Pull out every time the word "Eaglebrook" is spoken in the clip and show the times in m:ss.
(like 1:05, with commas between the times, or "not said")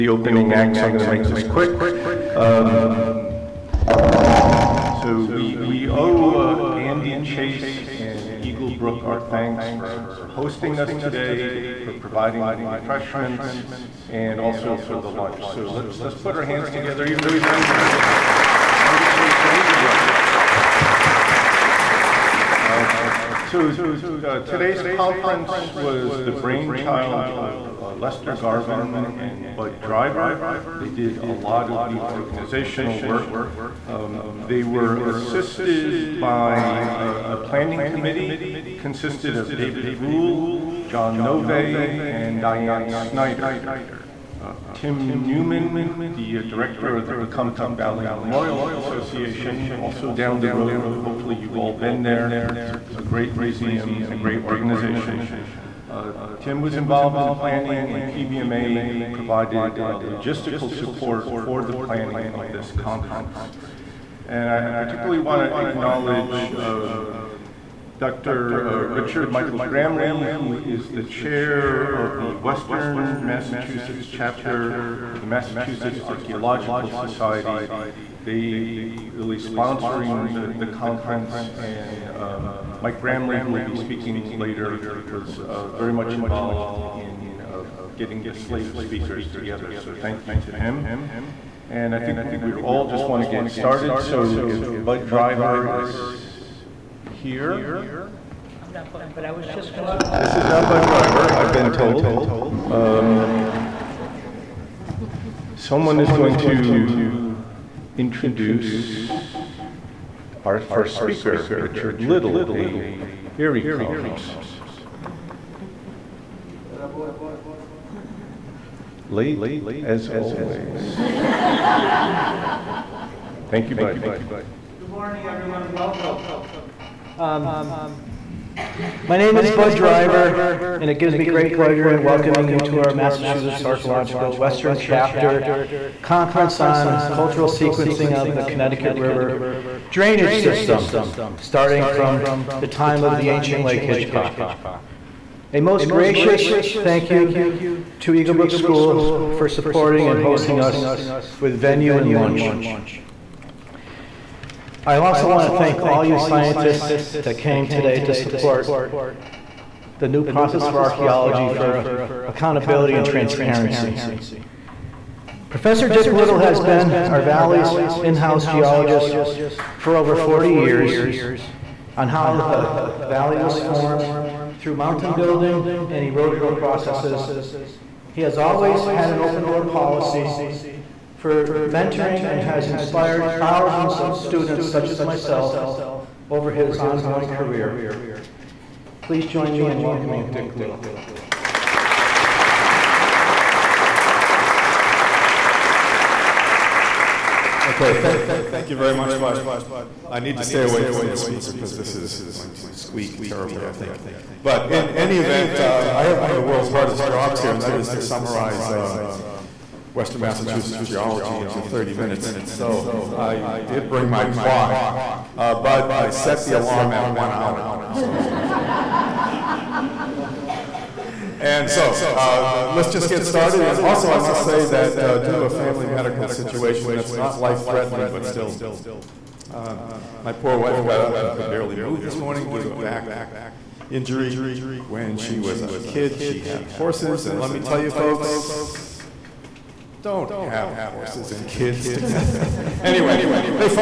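0:08, 2:28.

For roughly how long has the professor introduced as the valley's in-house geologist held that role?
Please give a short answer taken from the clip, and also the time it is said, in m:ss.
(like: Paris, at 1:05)
40 years, at 2:50.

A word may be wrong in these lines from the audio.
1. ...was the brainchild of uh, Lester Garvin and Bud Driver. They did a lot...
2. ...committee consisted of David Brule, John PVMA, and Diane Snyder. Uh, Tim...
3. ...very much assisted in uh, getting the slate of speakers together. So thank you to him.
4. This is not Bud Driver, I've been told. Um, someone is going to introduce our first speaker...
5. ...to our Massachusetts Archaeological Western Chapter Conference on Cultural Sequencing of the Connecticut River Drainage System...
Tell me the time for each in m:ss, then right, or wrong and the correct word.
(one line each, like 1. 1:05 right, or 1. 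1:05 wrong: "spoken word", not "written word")
1. 0:25 right
2. 0:37 wrong: "Nove", not "PVMA"
3. 1:25 wrong: "involved", not "assisted"
4. 1:40 right
5. 2:12 right.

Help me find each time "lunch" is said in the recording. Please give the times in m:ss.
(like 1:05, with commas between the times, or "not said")
0:15, 2:32.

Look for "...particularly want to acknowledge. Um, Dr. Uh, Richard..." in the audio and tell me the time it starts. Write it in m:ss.
1:04.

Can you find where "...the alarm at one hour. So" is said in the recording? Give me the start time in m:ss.
3:36.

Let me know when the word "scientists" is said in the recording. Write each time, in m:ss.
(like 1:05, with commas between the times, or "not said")
2:36.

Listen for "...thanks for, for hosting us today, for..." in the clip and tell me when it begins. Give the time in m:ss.
0:09.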